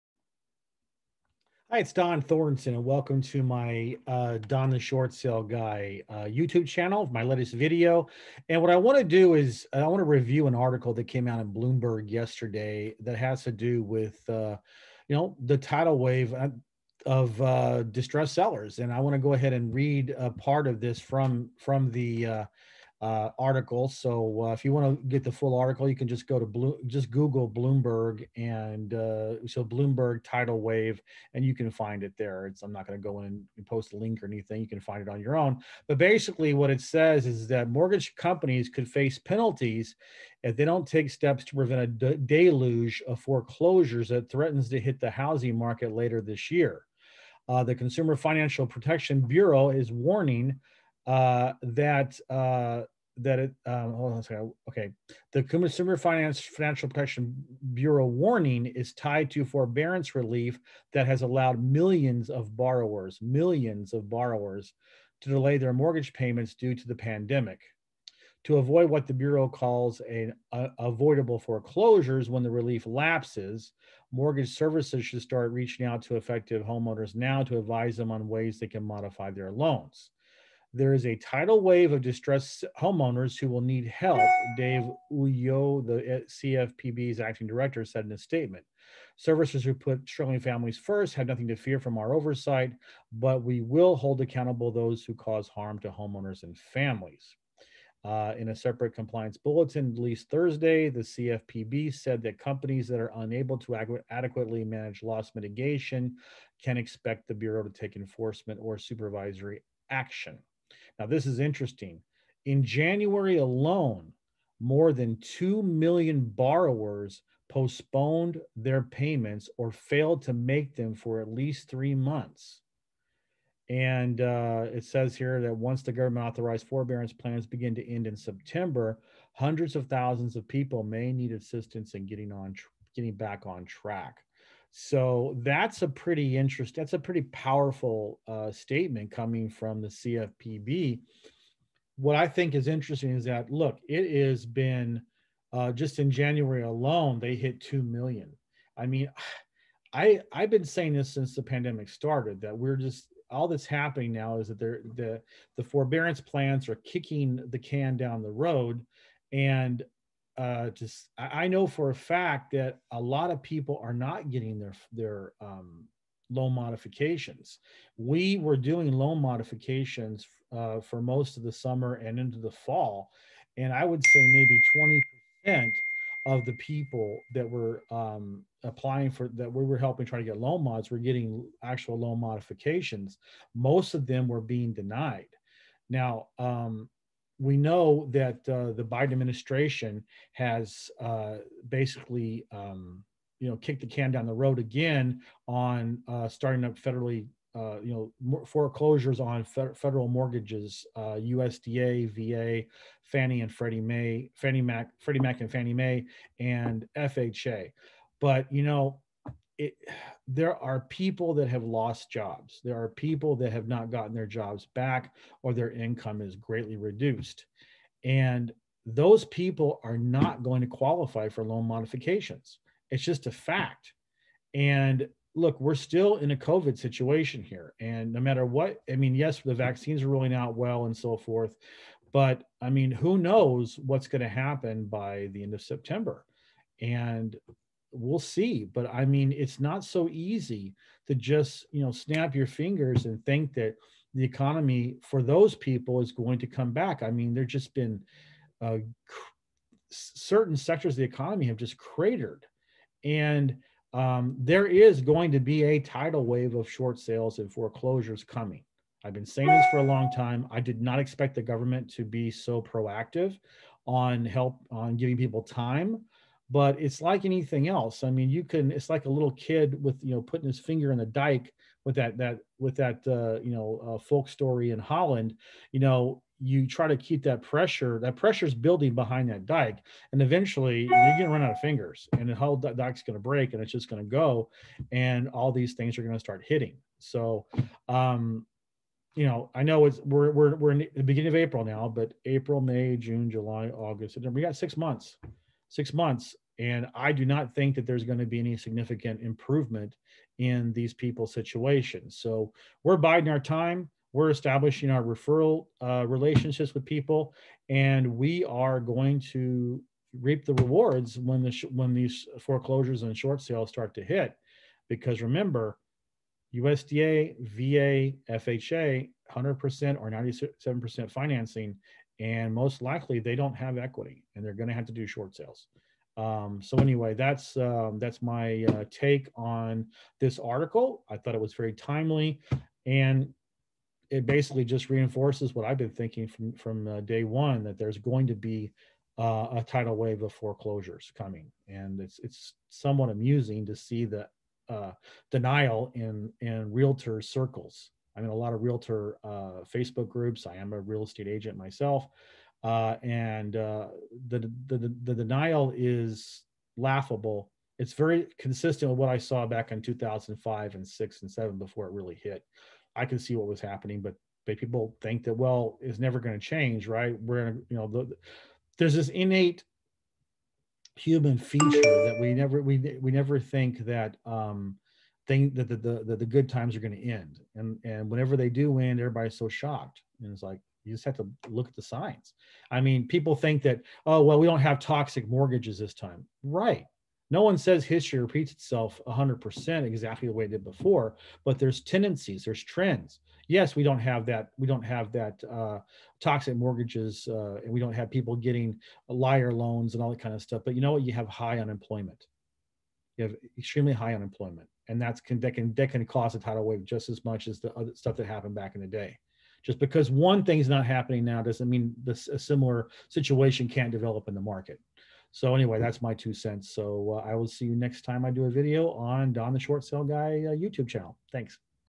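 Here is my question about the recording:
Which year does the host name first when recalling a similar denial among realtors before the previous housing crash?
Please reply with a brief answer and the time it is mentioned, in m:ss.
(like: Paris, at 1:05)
2005, at 5:59.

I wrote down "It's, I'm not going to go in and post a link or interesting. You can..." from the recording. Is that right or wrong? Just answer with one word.
wrong.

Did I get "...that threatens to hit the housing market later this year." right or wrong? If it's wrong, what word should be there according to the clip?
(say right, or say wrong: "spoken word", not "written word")
right.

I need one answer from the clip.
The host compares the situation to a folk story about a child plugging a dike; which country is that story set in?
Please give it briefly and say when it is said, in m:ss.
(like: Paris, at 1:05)
Holland, at 4:34.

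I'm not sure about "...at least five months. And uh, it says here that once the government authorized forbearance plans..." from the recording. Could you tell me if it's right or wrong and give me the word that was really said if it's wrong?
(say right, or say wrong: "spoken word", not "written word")
wrong: "three", not "five".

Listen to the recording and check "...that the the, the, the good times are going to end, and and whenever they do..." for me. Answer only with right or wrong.
right.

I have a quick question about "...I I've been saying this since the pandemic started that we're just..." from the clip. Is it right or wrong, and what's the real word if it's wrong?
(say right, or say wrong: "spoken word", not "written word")
right.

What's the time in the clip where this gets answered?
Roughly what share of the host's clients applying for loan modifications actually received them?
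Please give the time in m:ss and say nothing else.
2:54.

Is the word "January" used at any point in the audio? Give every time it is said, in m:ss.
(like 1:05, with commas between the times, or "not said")
1:52, 2:26.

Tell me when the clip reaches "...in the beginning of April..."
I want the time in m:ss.
4:50.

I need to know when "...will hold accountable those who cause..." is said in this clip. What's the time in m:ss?
1:33.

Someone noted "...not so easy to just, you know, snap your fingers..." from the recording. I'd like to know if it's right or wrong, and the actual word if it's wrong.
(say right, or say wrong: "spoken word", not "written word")
right.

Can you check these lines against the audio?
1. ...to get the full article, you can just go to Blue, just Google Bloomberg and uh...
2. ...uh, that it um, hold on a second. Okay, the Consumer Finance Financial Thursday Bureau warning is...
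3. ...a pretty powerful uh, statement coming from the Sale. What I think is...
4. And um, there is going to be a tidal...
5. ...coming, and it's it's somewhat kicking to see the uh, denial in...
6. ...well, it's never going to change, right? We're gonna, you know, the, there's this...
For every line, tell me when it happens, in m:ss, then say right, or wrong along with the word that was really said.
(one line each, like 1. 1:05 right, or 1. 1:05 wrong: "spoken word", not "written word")
1. 0:25 right
2. 0:52 wrong: "Protection", not "Thursday"
3. 2:16 wrong: "CFPB", not "Sale"
4. 4:13 right
5. 5:41 wrong: "amusing", not "kicking"
6. 6:05 right.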